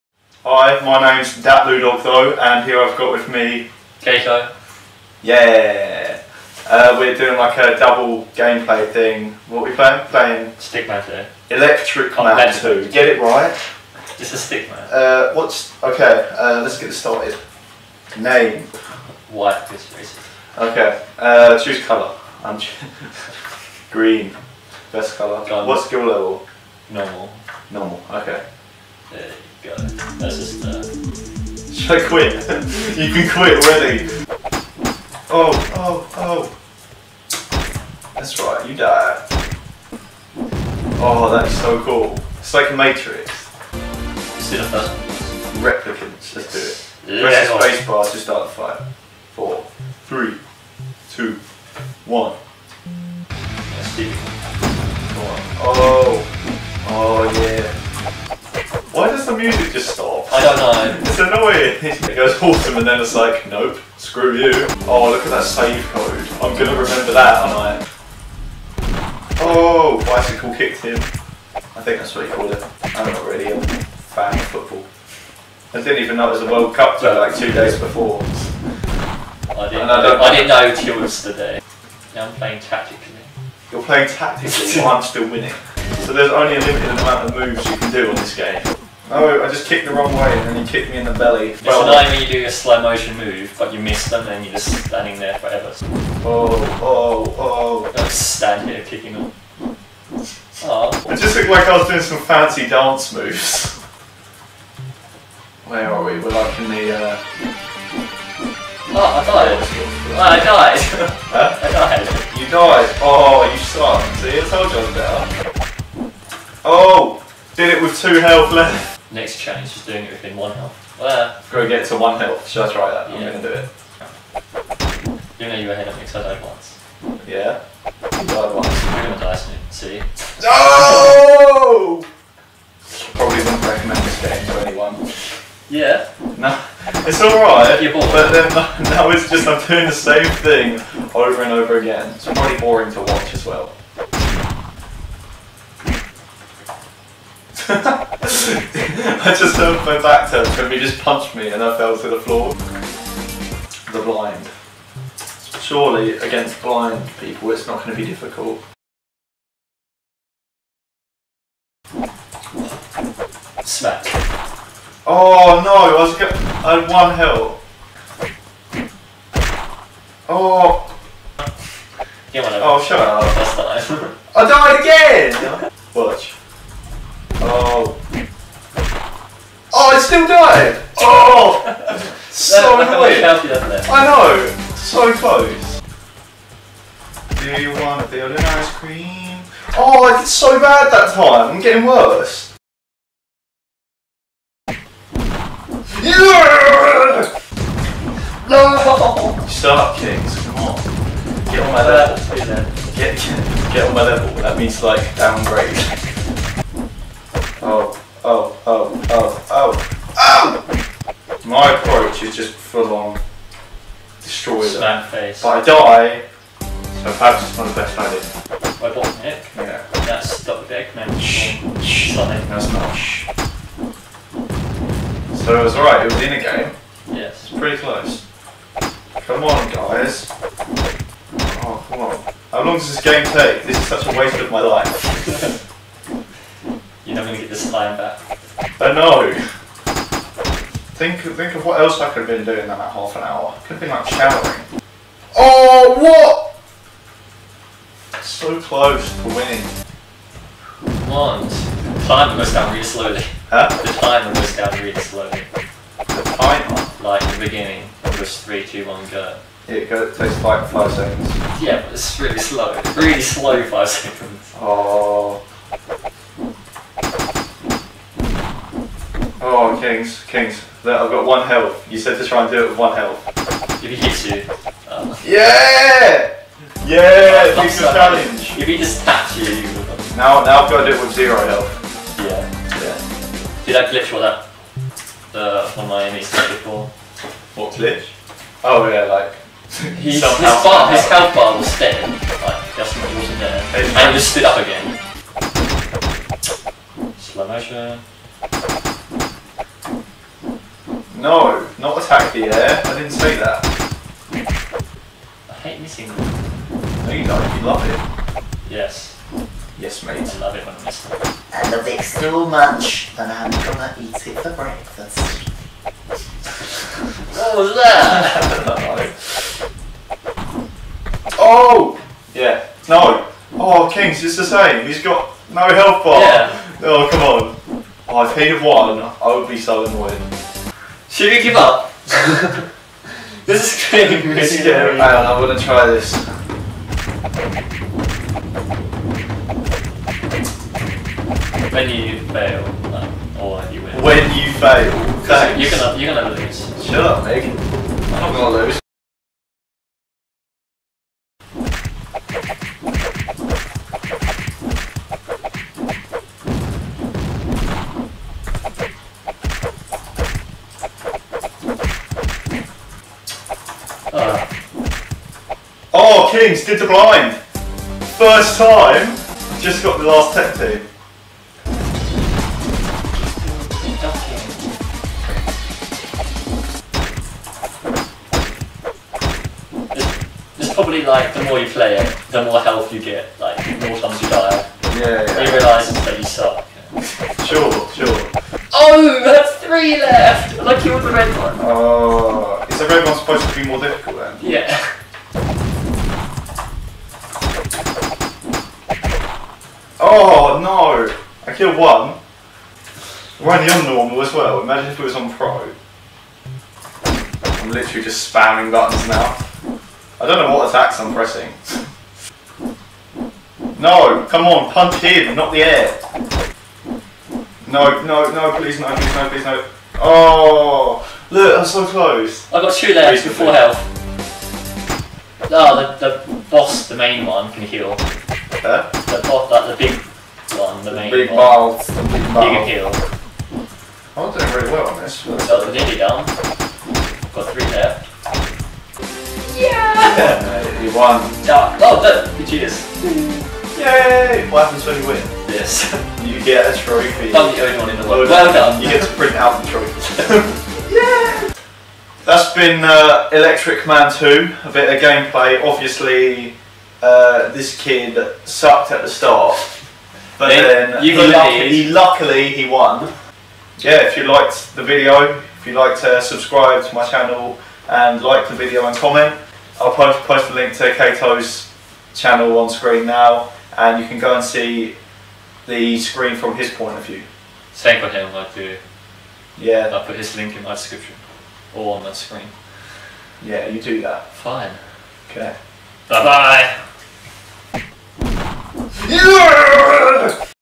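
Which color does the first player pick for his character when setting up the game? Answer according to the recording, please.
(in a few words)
Green.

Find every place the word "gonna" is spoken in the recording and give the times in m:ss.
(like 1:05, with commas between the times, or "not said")
1:06, 2:03, 2:09, 5:13, 5:48.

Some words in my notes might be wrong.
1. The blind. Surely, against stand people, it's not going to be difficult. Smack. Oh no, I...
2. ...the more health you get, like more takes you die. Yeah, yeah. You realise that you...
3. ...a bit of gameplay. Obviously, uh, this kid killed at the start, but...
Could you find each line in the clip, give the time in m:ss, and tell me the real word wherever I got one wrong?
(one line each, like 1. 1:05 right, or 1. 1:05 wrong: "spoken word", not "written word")
1. 2:33 wrong: "blind", not "stand"
2. 6:22 wrong: "times", not "takes"
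3. 7:34 wrong: "sucked", not "killed".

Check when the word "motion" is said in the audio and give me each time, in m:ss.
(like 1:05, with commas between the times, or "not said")
1:32, 4:57.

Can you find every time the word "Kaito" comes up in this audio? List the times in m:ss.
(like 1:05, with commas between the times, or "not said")
0:04, 7:50.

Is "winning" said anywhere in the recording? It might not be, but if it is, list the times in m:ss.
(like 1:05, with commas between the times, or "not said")
1:25, 4:09.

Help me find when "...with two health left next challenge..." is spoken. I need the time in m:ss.
1:57.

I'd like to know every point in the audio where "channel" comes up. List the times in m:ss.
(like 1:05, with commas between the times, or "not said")
7:47, 7:52.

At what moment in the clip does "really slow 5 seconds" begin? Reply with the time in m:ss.
4:22.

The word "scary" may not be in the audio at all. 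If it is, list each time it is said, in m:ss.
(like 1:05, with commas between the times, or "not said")
5:34.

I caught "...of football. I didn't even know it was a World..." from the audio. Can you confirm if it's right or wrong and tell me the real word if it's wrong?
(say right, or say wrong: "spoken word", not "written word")
right.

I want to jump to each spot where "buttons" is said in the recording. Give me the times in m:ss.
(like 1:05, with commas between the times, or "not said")
6:48.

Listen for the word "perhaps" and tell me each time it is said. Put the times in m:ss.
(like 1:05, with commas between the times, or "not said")
3:37.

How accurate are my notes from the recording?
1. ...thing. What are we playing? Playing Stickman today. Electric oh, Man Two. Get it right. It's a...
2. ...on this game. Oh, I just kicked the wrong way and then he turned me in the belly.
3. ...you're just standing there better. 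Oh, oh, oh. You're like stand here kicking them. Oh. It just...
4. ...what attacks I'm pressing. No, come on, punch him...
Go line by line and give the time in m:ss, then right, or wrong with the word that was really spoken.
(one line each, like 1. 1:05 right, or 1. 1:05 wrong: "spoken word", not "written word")
1. 0:08 right
2. 1:28 wrong: "kicked", not "turned"
3. 1:34 wrong: "forever", not "better"
4. 6:50 right.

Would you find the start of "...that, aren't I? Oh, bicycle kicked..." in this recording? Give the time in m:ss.
1:07.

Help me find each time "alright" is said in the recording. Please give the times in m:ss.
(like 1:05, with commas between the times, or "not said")
2:17, 3:45.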